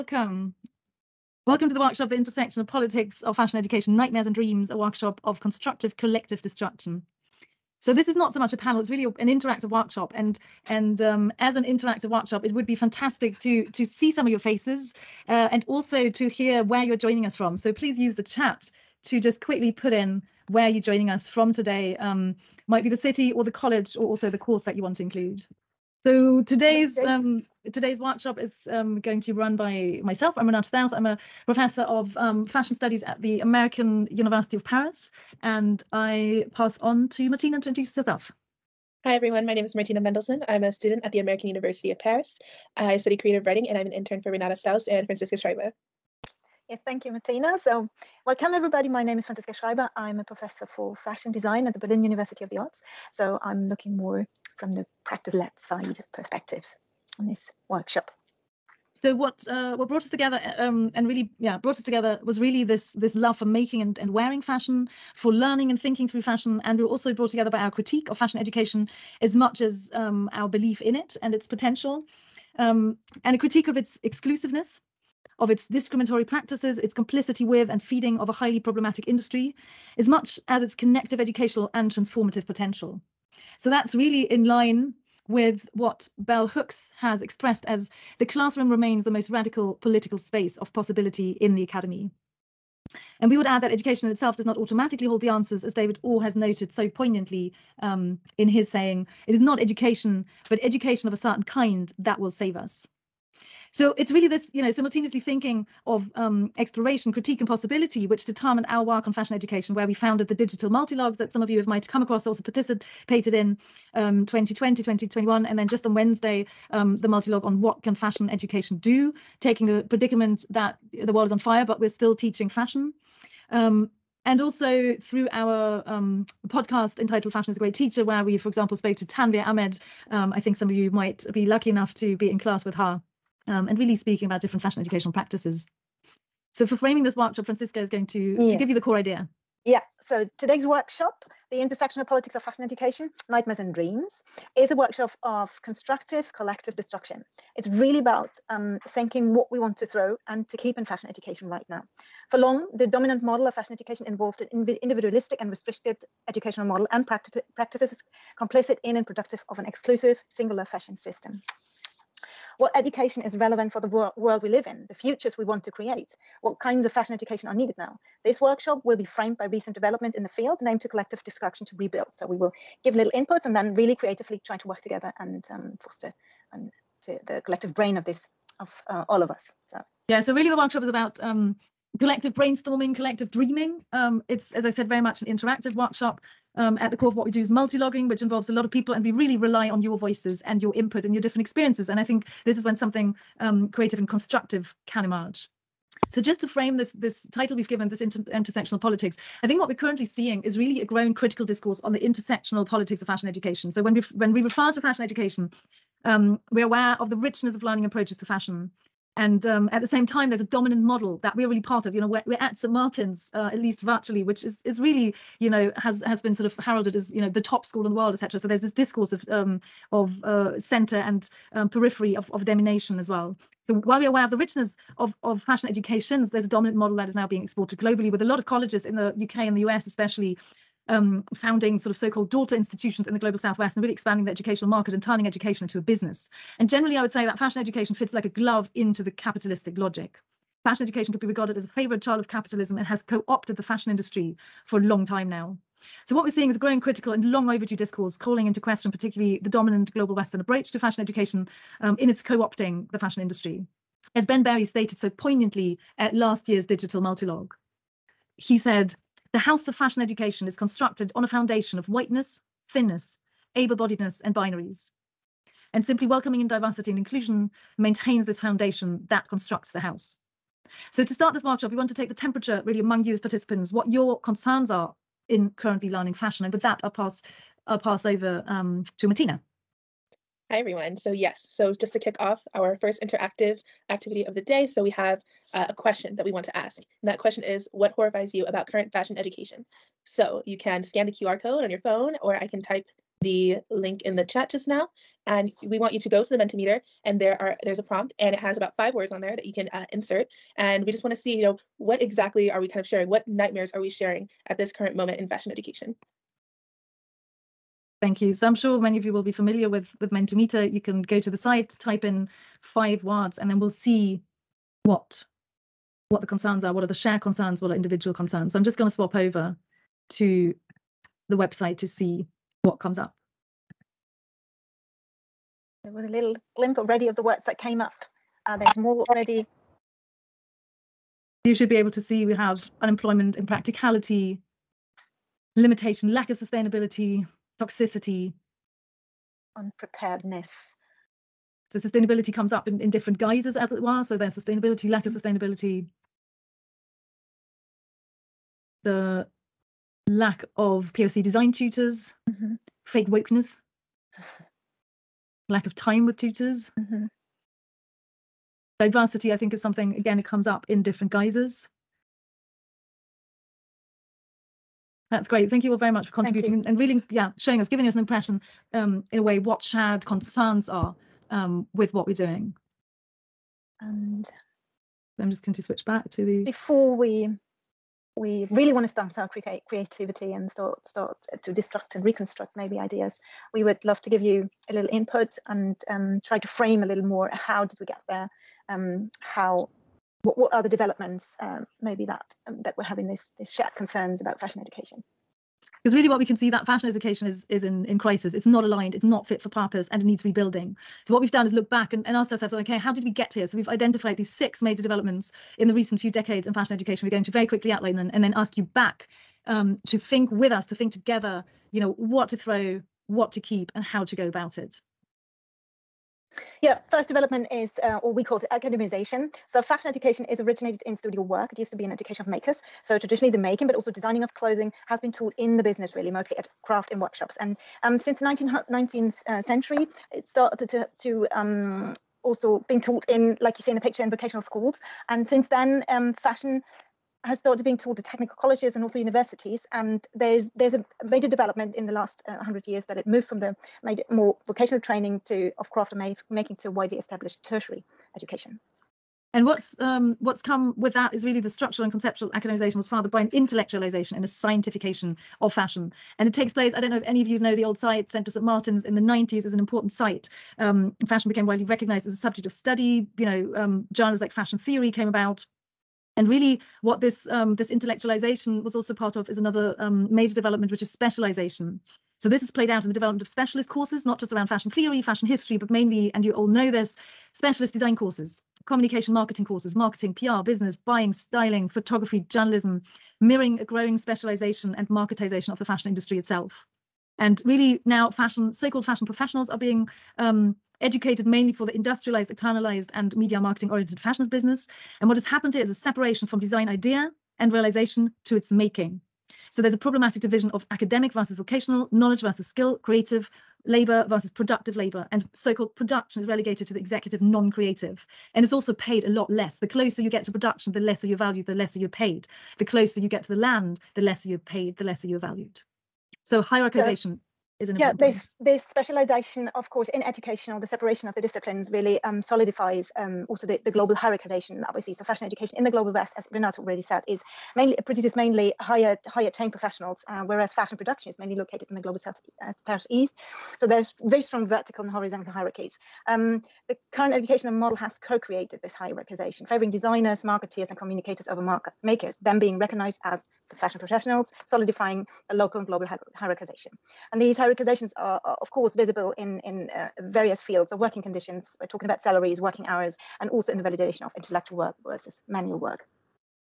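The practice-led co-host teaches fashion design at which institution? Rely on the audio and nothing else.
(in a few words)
Berlin University of the Arts.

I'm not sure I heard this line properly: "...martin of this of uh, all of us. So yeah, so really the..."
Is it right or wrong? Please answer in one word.
wrong.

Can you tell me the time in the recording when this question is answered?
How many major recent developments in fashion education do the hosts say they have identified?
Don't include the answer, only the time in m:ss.
6:44.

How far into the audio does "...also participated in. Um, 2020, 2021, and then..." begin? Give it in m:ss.
1:52.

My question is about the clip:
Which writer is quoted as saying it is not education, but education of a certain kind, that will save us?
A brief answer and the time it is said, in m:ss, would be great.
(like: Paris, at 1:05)
David Orr, at 1:35.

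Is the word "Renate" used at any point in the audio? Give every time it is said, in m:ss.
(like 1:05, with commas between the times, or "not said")
0:30, 0:44, 8:46.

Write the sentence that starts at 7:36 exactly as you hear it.
And it takes place, I don't know if any of you know the old site, Central St.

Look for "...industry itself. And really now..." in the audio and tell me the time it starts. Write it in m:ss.
8:05.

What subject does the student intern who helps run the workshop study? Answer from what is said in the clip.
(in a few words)
Creative writing.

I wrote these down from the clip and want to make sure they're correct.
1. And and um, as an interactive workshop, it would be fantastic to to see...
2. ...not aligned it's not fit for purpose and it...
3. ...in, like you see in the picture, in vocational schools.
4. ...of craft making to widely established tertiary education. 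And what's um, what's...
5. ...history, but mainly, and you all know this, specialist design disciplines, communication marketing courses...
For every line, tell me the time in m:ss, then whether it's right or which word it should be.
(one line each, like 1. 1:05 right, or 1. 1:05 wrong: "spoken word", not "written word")
1. 0:10 right
2. 6:38 right
3. 7:13 right
4. 7:25 right
5. 7:55 wrong: "courses", not "disciplines".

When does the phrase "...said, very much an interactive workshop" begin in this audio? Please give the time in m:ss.
3:04.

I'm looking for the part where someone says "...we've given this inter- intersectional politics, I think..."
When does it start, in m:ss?
3:17.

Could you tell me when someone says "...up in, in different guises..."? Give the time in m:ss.
5:42.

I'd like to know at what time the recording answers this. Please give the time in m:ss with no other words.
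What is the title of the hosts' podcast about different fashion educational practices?
2:07.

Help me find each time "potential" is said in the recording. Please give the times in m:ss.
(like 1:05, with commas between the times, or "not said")
1:11, 1:22.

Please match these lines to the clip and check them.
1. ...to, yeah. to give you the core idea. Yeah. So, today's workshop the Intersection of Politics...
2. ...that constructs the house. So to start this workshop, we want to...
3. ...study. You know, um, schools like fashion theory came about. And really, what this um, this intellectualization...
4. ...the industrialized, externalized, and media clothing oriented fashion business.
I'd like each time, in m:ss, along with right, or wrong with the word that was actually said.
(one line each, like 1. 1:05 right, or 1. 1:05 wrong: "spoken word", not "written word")
1. 2:18 right
2. 4:29 right
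3. 7:42 wrong: "journals", not "schools"
4. 8:11 wrong: "marketing", not "clothing".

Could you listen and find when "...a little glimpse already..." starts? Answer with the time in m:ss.
5:26.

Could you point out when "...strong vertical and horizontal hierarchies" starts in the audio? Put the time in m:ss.
8:54.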